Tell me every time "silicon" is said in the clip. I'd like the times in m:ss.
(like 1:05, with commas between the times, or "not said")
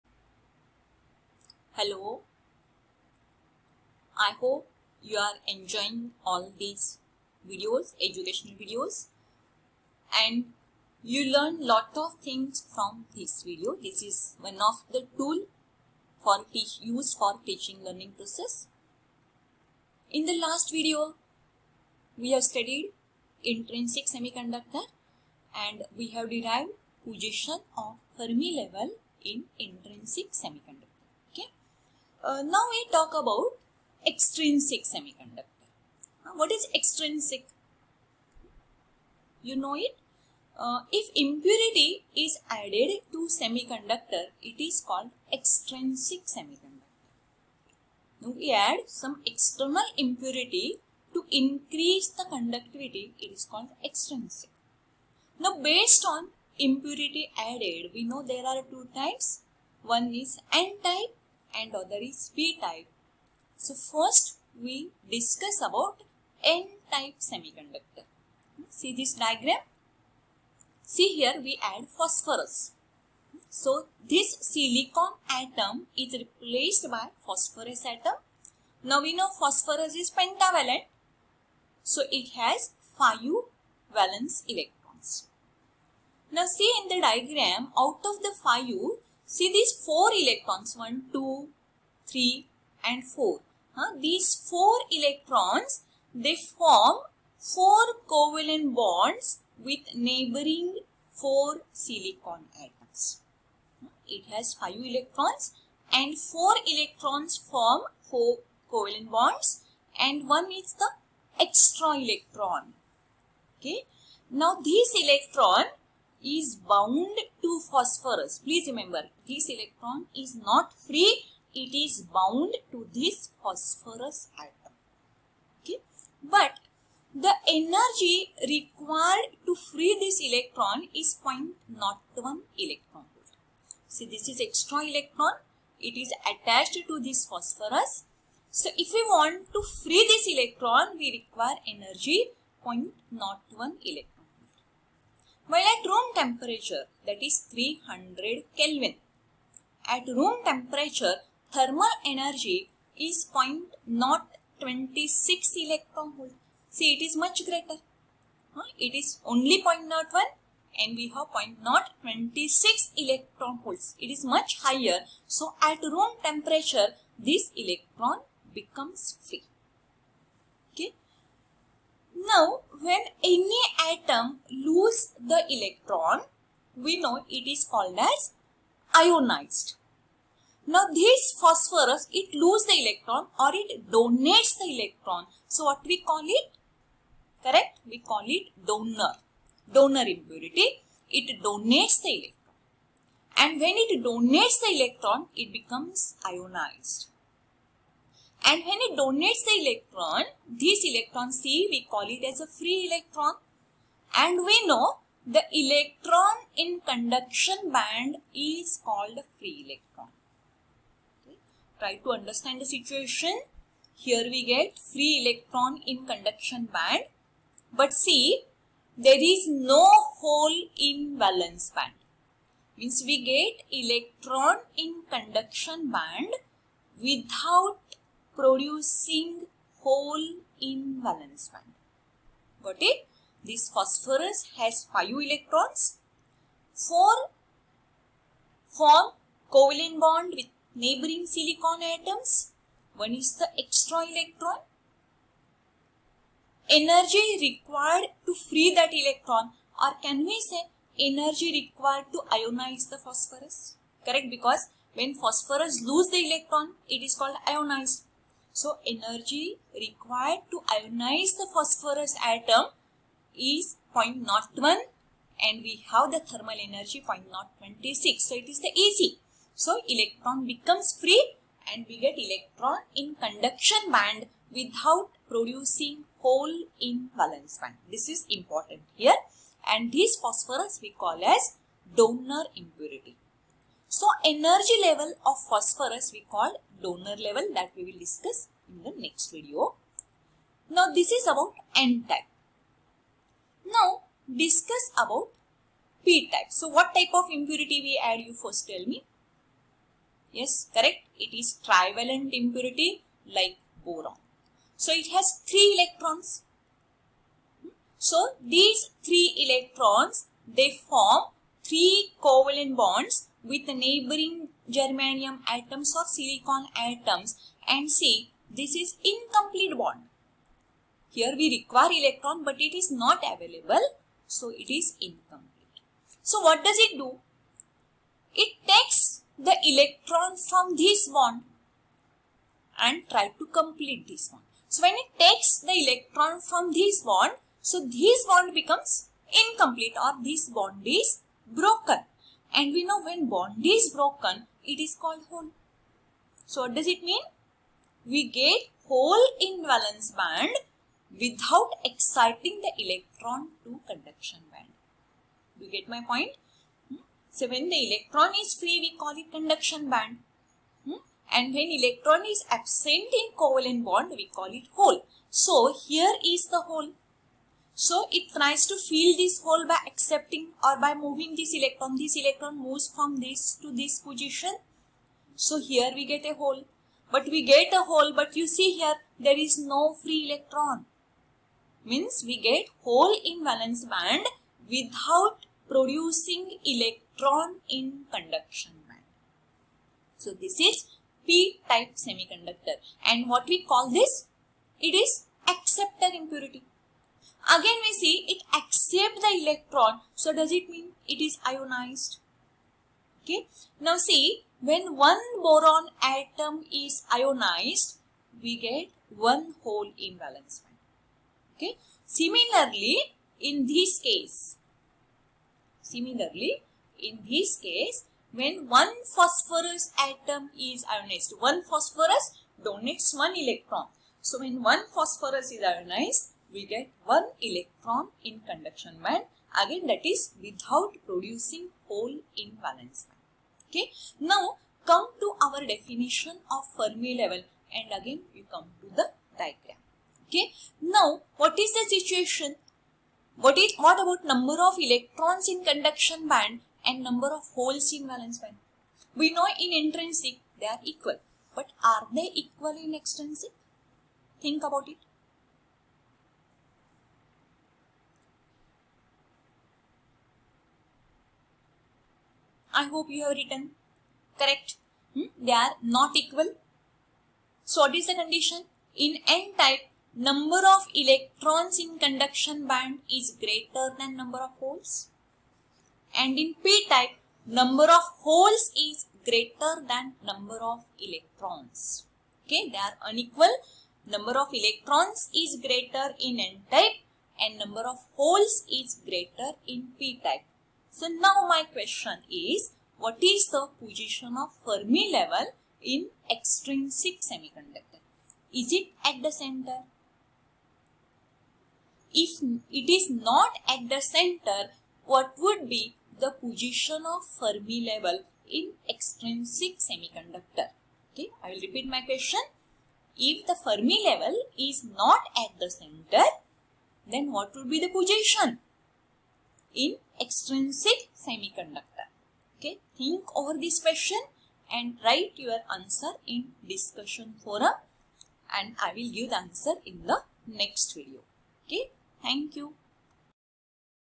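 1:14, 1:41, 4:01, 5:16.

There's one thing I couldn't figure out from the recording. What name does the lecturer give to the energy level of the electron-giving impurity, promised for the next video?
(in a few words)
Donor level.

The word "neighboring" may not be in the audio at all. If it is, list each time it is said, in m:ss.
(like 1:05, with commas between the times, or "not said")
1:39, 4:00, 5:13.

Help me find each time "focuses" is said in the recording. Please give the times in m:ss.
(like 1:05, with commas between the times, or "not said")
not said.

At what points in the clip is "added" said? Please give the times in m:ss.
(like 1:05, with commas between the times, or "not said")
0:42, 0:57.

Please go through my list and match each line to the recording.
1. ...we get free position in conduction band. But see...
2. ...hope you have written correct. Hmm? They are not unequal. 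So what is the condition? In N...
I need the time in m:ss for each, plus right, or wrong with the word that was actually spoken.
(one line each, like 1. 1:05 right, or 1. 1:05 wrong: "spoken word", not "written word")
1. 3:34 wrong: "electron", not "position"
2. 7:42 wrong: "equal", not "unequal".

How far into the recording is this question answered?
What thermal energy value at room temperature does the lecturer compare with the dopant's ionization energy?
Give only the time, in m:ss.
2:33.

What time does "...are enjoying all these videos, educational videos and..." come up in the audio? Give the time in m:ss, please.
0:05.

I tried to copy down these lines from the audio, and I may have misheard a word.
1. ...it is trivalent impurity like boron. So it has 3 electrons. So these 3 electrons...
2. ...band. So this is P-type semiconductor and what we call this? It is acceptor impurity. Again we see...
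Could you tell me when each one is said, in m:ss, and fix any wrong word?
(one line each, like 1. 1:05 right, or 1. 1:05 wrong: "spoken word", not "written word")
1. 5:01 right
2. 6:28 right.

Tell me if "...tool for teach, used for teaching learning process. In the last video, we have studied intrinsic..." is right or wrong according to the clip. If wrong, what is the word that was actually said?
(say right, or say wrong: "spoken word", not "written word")
right.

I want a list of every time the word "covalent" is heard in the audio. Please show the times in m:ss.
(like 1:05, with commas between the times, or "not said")
1:38, 1:48, 3:59, 5:12, 6:03.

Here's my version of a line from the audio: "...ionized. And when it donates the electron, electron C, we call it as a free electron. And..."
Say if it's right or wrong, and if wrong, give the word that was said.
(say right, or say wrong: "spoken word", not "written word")
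right.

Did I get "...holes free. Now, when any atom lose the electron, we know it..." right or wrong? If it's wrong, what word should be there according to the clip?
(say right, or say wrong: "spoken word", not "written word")
wrong: "becomes", not "holes".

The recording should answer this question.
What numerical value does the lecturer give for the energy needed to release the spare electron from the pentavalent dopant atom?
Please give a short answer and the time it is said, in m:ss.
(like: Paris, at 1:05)
0.01 eV, at 2:11.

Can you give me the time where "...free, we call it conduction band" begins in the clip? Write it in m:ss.
5:58.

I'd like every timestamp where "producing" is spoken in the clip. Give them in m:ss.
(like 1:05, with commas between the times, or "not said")
3:48, 4:35, 6:25, 7:11.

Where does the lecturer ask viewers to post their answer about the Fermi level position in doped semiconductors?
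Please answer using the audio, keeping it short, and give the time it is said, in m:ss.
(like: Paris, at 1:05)
Discussion forum, at 8:46.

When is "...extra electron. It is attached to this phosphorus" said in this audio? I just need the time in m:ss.
2:14.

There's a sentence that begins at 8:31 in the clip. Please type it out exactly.
Okay, I will repeat my question.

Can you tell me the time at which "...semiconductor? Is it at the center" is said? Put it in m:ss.
8:17.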